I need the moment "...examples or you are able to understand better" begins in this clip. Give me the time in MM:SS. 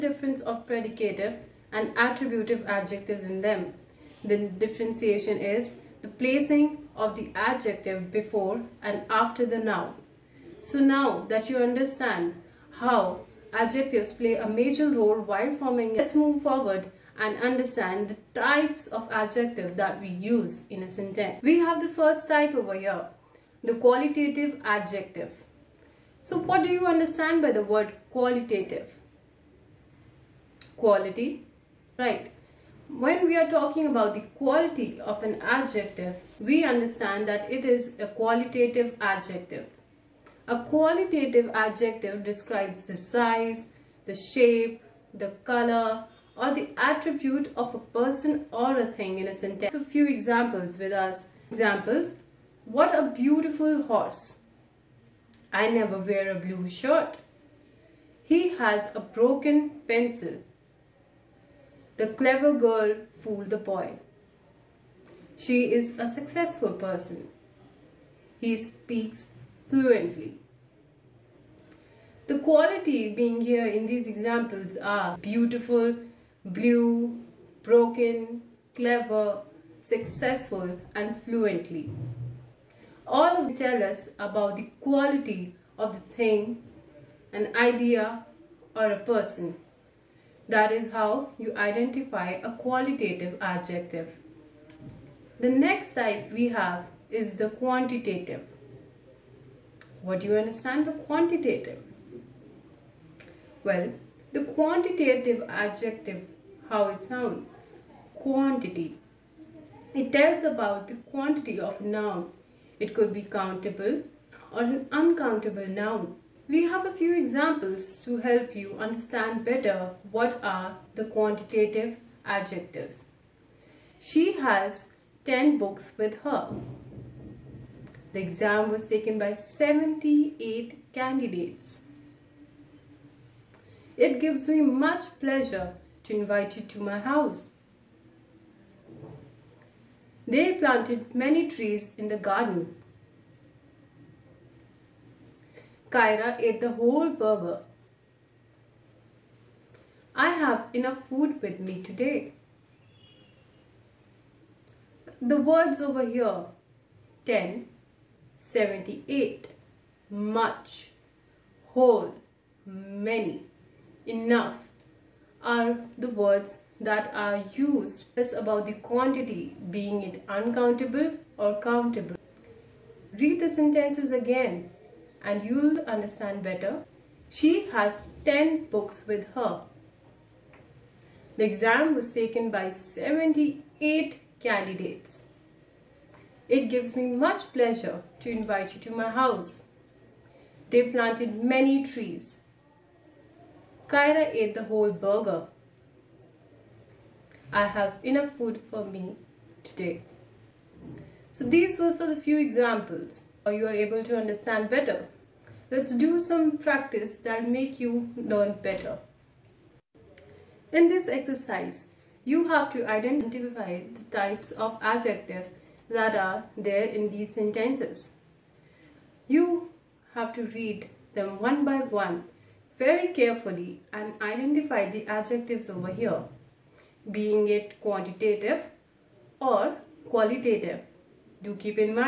03:22.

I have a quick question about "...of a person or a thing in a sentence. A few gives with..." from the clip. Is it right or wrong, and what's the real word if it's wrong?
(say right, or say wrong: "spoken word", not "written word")
wrong: "examples", not "gives".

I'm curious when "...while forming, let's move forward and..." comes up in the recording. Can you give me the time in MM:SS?
00:15.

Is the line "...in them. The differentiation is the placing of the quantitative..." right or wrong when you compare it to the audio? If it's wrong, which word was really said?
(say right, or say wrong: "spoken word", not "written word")
wrong: "adjective", not "quantitative".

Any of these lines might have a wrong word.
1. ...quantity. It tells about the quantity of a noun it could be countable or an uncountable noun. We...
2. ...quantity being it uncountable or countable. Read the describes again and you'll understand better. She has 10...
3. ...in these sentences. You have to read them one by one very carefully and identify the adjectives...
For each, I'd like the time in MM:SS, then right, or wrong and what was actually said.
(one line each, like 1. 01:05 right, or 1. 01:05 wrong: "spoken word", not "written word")
1. 01:48 right
2. 02:48 wrong: "sentences", not "describes"
3. 03:36 right.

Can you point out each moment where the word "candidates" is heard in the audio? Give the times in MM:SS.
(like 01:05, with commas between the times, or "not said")
02:10, 03:04.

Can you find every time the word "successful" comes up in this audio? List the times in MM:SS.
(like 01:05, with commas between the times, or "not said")
01:06, 01:19.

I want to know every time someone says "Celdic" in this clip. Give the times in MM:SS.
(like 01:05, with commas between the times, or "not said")
not said.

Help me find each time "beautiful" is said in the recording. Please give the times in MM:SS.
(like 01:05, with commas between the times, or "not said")
00:53, 01:15.